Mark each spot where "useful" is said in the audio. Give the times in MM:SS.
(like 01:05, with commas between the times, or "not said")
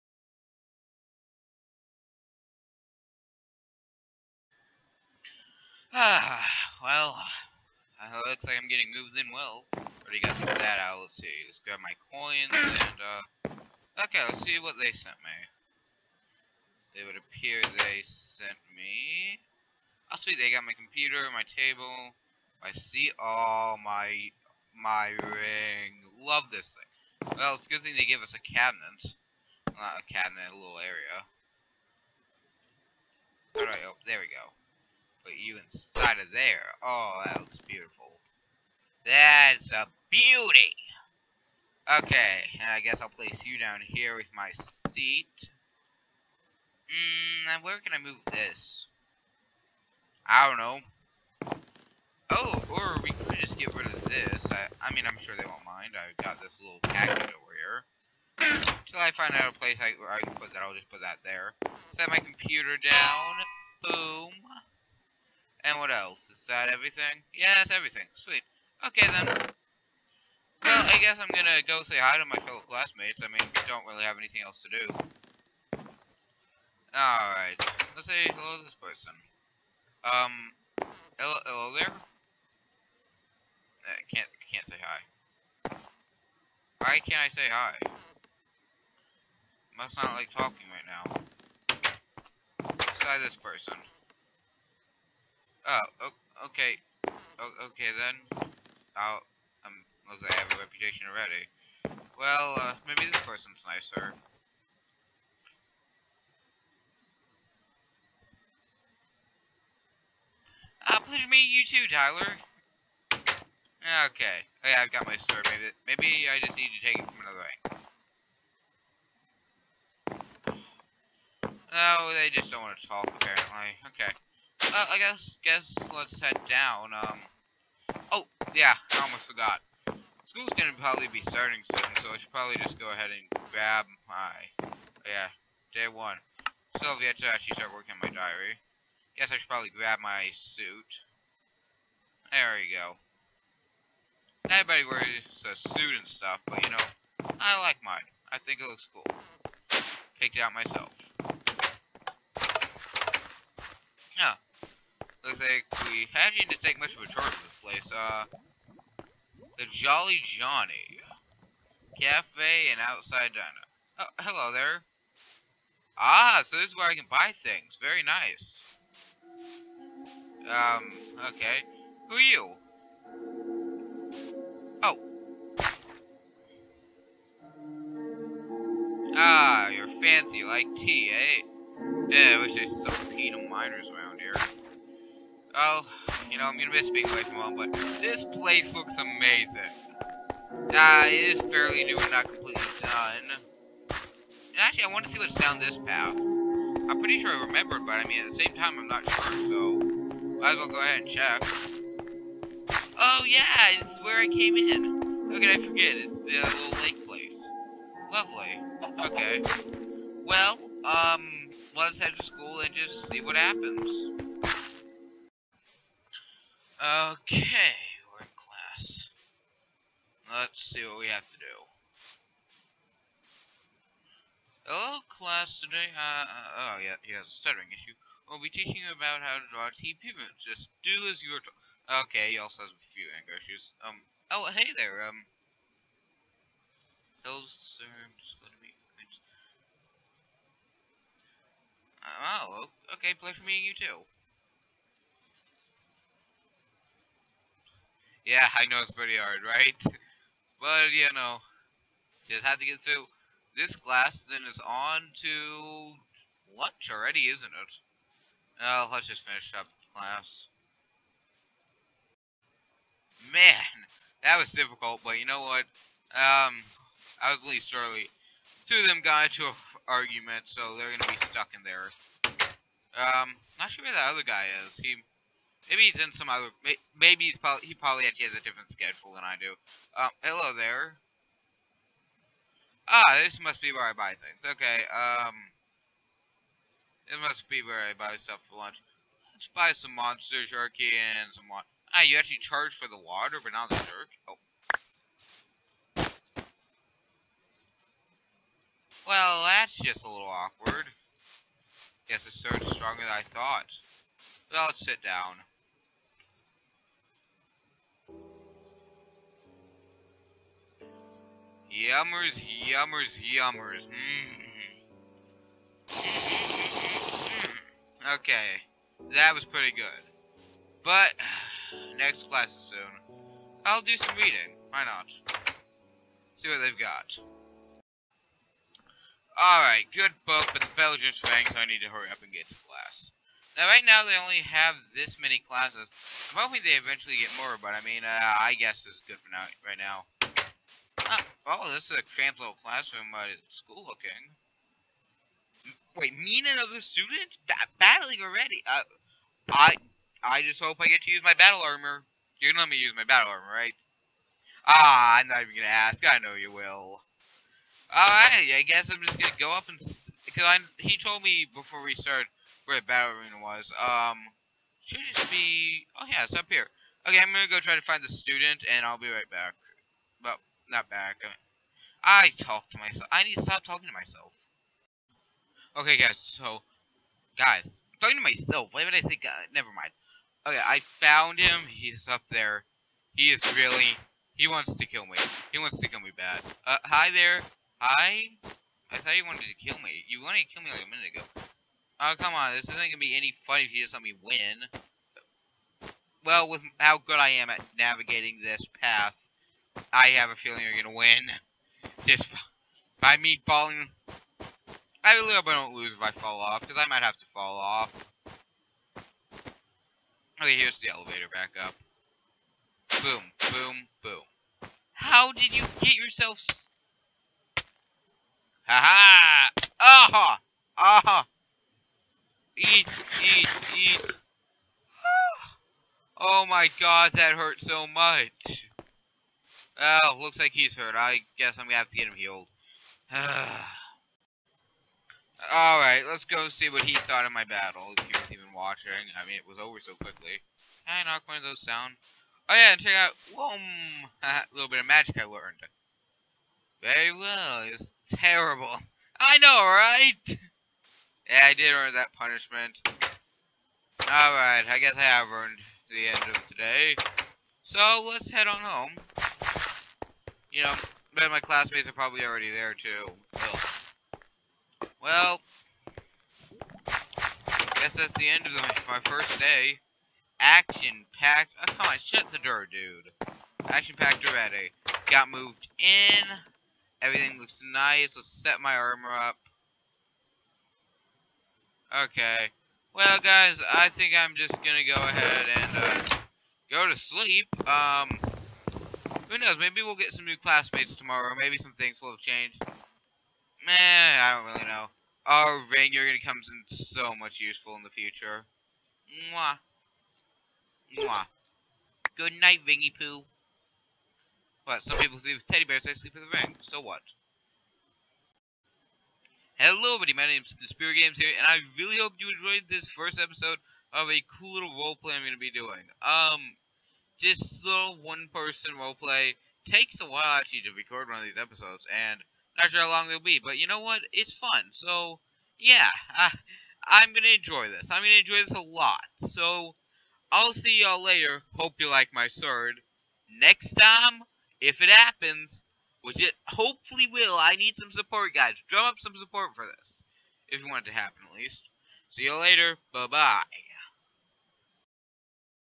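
08:17.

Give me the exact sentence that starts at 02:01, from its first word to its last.
Oh, they just don't want to talk, apparently.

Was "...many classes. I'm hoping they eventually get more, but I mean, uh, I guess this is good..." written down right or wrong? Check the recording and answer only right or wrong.
right.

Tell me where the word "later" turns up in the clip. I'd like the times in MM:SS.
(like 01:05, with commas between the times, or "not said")
08:51, 09:02.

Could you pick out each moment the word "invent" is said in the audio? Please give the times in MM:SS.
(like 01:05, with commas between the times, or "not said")
not said.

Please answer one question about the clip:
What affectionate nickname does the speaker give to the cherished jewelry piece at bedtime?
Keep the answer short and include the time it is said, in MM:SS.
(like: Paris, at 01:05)
Ringy Poo, at 08:22.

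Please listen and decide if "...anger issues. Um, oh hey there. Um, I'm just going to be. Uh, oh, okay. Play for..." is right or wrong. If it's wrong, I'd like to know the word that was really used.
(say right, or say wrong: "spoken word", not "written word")
right.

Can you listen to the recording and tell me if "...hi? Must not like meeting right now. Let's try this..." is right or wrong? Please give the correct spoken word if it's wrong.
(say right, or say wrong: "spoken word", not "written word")
wrong: "talking", not "meeting".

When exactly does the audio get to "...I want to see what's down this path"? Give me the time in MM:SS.
03:14.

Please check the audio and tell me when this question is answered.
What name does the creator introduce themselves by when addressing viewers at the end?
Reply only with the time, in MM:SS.
08:30.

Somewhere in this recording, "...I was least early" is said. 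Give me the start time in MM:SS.
04:27.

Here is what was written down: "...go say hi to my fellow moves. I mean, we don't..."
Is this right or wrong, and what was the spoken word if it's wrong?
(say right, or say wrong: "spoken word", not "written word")
wrong: "classmates", not "moves".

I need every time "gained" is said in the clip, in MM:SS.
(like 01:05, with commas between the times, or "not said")
not said.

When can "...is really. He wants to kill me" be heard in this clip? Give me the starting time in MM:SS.
06:23.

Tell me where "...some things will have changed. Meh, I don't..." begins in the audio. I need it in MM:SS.
08:11.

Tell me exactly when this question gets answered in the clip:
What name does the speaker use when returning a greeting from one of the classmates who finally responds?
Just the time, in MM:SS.
01:51.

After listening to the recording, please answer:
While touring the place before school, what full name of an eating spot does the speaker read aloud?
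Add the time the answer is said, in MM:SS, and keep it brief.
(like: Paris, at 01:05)
Jolly Johnny Cafe and Outside Diner, at 02:39.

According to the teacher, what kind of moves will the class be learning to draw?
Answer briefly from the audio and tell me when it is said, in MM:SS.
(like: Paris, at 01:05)
TP moves, at 03:49.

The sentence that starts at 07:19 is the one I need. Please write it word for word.
I mean, it was over so quickly.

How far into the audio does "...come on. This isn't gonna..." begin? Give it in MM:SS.
06:32.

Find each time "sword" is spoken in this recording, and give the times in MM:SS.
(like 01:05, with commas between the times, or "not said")
01:55, 08:52.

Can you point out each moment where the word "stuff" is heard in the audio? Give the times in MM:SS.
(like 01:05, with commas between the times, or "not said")
02:26, 04:48.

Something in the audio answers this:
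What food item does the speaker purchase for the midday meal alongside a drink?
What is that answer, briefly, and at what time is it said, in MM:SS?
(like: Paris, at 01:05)
monster jerky, at 04:49.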